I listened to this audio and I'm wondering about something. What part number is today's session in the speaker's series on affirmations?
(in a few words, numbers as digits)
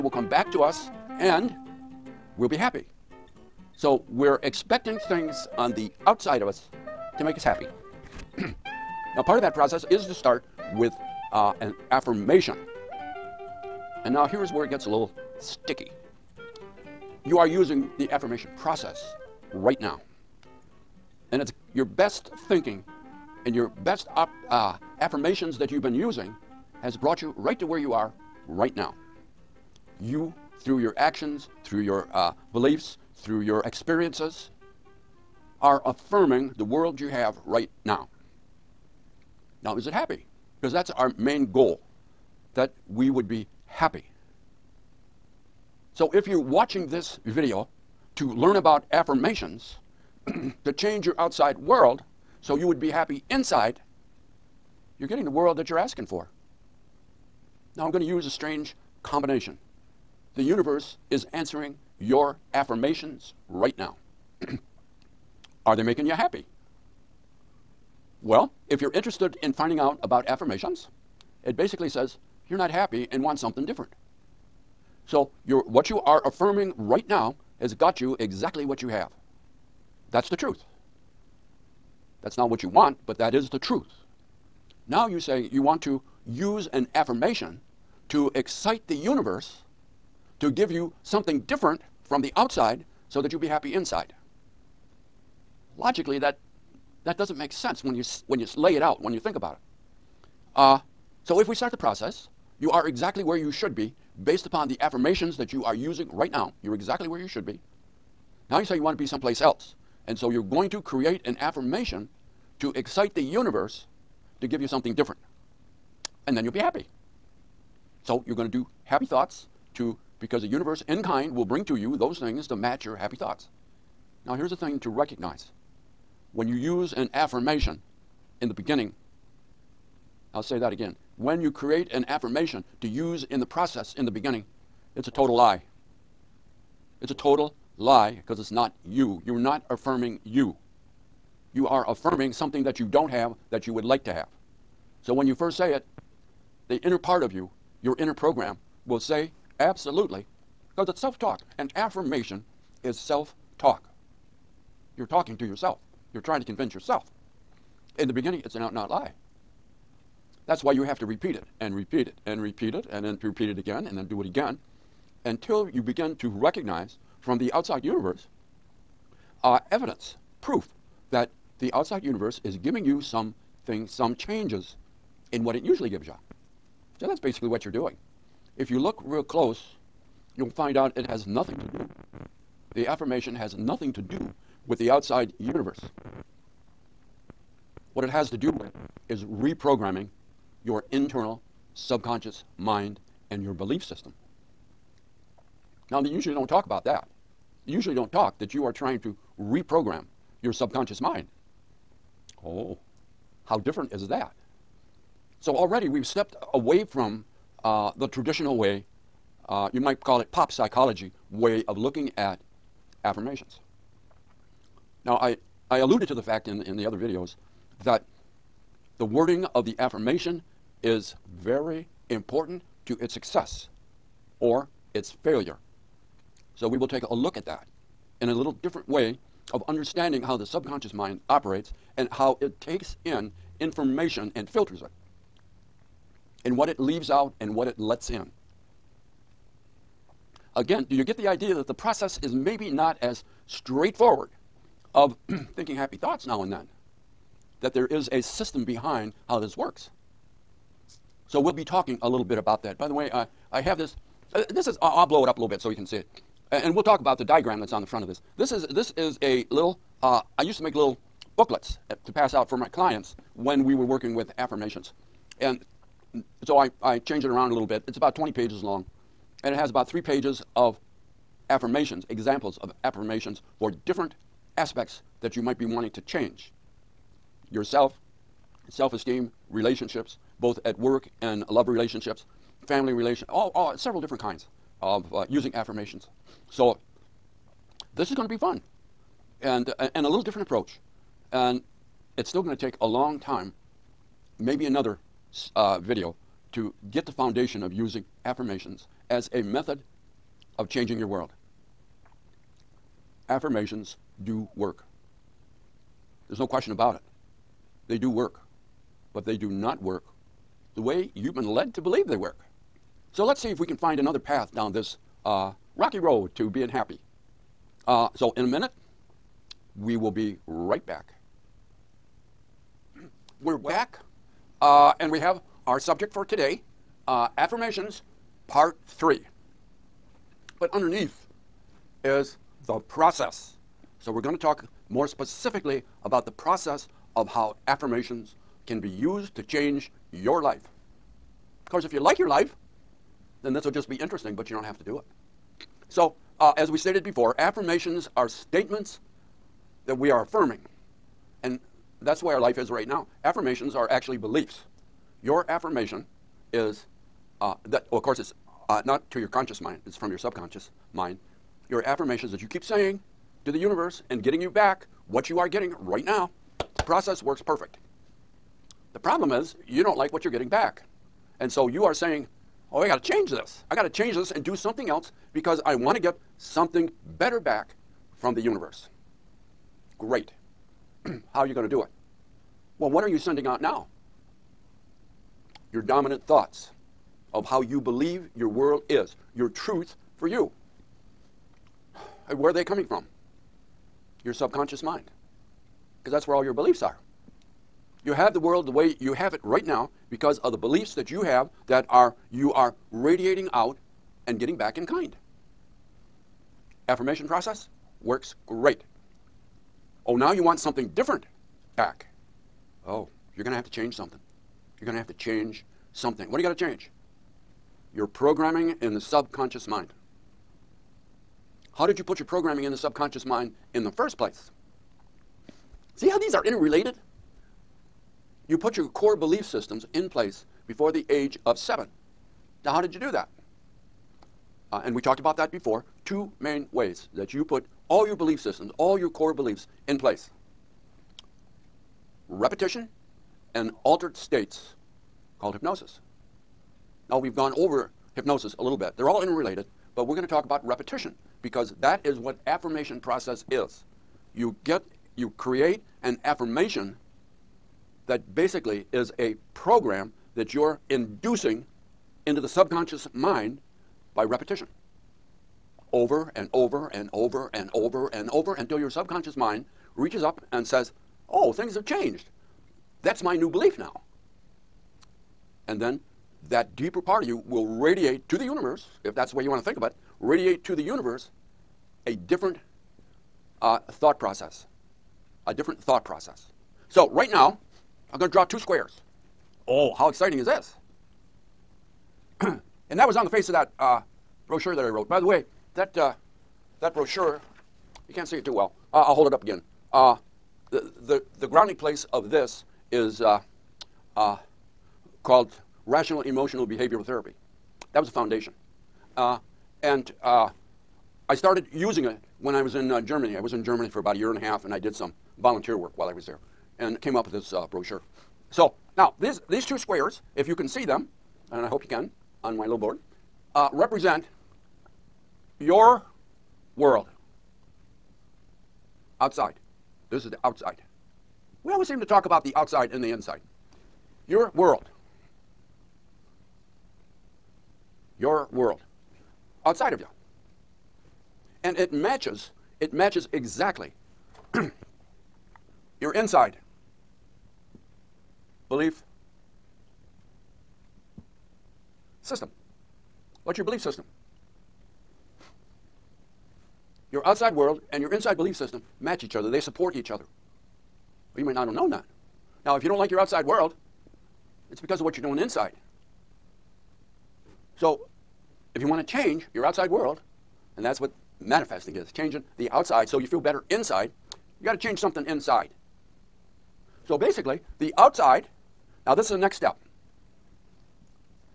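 3.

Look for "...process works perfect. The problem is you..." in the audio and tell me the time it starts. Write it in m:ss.
6:06.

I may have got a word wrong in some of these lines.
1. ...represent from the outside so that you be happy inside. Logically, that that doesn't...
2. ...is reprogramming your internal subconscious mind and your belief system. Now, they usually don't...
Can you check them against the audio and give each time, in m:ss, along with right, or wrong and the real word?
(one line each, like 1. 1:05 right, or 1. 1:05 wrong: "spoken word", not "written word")
1. 1:31 wrong: "different", not "represent"
2. 3:09 right.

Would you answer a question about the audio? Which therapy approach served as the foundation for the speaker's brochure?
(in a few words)
Rational emotional behavioral therapy.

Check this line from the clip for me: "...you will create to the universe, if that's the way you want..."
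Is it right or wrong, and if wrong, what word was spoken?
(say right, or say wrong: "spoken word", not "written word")
wrong: "radiate", not "create".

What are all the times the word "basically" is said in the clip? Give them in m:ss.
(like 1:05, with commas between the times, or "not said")
1:11, 2:57, 7:38, 9:37.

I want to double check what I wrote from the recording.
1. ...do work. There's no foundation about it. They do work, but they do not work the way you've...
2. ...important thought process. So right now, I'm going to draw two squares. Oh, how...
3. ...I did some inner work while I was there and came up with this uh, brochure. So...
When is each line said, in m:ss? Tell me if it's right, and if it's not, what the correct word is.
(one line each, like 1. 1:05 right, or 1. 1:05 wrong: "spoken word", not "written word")
1. 5:04 wrong: "question", not "foundation"
2. 8:05 wrong: "different", not "important"
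3. 8:34 wrong: "volunteer", not "inner".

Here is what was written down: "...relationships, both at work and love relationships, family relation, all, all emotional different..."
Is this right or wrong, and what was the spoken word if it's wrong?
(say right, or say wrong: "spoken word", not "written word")
wrong: "several", not "emotional".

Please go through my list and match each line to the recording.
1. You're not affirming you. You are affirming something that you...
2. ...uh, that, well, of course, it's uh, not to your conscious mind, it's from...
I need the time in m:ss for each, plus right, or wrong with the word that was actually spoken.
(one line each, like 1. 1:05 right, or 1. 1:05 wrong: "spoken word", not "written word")
1. 2:19 right
2. 5:57 right.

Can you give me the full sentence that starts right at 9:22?
Now, if you don't like your outside world, it's because of what you're doing inside.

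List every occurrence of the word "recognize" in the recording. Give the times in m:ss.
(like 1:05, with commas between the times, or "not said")
2:04, 2:46.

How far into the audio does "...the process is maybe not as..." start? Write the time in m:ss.
4:01.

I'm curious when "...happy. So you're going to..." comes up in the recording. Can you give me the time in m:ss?
1:56.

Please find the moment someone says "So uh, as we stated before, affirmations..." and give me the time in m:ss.
5:45.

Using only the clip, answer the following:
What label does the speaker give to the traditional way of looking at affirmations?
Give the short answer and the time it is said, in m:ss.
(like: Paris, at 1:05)
Pop psychology, at 3:30.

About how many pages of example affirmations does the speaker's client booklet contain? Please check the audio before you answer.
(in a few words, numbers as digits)
3.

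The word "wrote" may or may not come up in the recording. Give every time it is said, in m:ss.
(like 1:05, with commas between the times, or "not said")
8:14.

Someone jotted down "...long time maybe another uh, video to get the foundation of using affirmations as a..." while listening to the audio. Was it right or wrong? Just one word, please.
right.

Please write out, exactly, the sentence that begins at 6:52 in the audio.
Oh, you're going to have to change something.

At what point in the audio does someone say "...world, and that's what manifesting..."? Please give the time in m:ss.
9:29.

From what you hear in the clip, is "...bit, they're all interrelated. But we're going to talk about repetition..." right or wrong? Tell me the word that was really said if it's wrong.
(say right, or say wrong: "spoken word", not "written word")
right.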